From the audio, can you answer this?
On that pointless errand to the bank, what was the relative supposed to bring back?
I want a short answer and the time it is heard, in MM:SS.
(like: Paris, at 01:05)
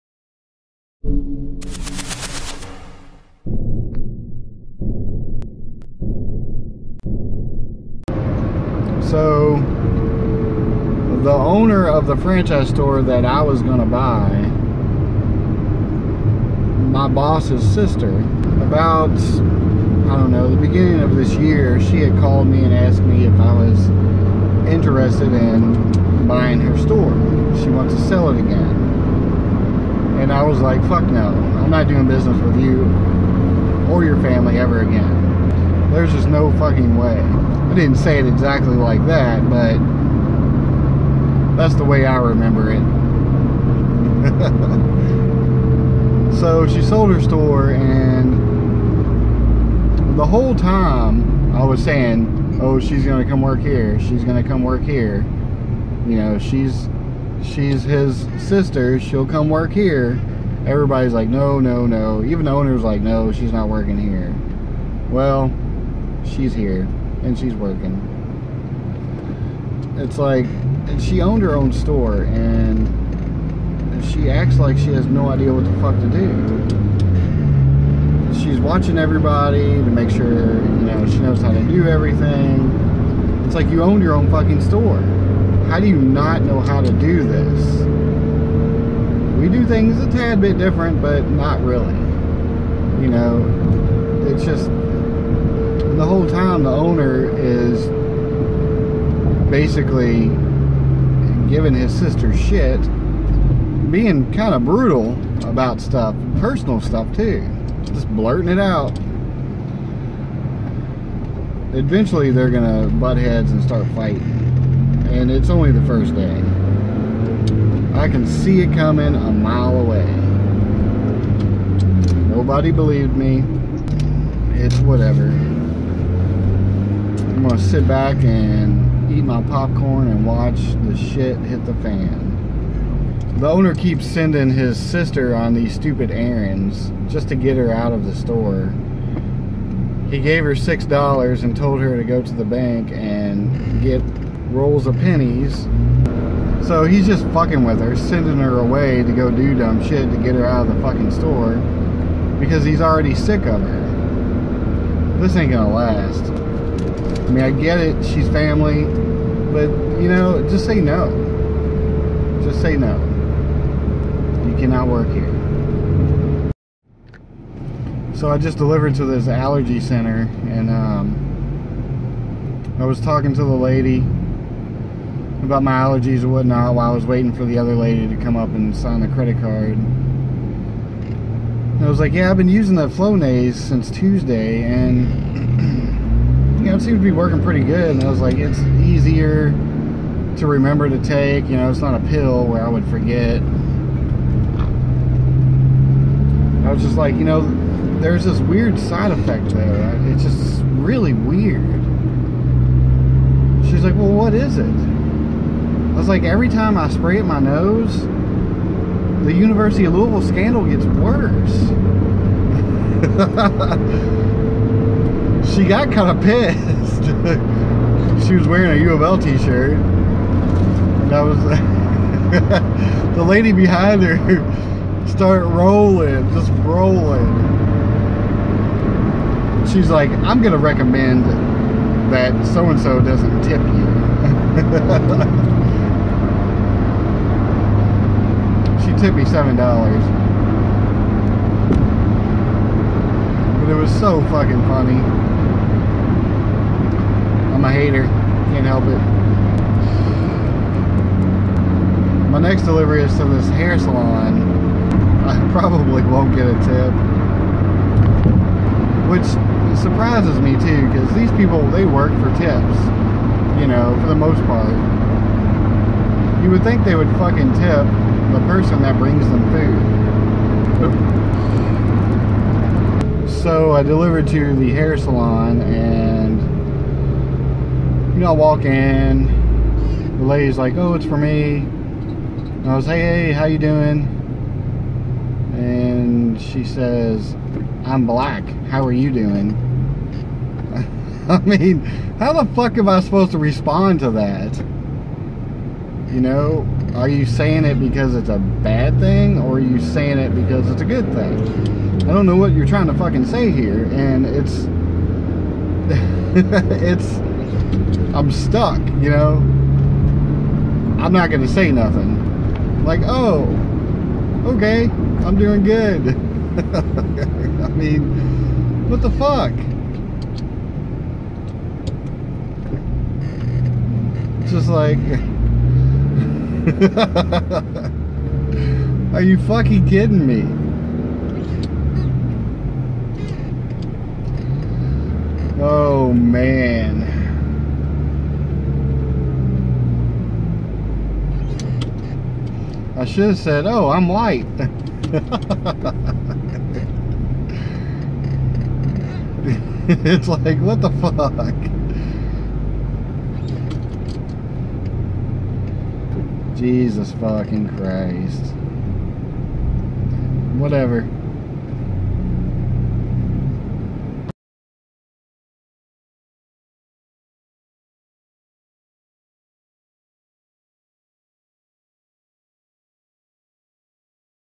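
Rolls of pennies, at 02:24.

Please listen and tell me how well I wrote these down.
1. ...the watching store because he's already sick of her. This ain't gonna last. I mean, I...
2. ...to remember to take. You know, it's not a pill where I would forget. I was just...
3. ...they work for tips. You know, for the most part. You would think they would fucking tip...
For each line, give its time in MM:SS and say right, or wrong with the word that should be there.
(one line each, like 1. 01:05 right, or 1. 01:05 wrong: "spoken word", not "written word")
1. 02:30 wrong: "fucking", not "watching"
2. 03:10 right
3. 04:21 right.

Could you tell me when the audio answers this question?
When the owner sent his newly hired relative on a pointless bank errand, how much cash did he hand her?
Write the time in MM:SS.
02:20.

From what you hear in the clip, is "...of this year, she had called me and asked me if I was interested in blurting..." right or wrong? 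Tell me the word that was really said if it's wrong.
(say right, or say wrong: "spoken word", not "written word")
wrong: "buying", not "blurting".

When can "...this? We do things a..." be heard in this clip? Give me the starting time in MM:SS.
01:27.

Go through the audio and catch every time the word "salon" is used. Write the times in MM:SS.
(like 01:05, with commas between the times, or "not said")
04:13, 04:34.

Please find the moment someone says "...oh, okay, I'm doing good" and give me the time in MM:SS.
05:13.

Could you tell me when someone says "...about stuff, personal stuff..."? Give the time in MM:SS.
01:45.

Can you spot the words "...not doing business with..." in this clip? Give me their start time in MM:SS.
00:31.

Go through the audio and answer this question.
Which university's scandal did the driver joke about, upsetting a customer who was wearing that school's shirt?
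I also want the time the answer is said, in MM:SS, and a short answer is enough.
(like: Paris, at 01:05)
University of Louisville, at 03:29.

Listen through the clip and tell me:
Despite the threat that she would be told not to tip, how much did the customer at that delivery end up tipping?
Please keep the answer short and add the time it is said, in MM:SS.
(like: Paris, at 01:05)
$7, at 03:59.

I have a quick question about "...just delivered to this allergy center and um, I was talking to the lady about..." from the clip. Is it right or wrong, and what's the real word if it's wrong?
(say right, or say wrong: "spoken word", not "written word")
right.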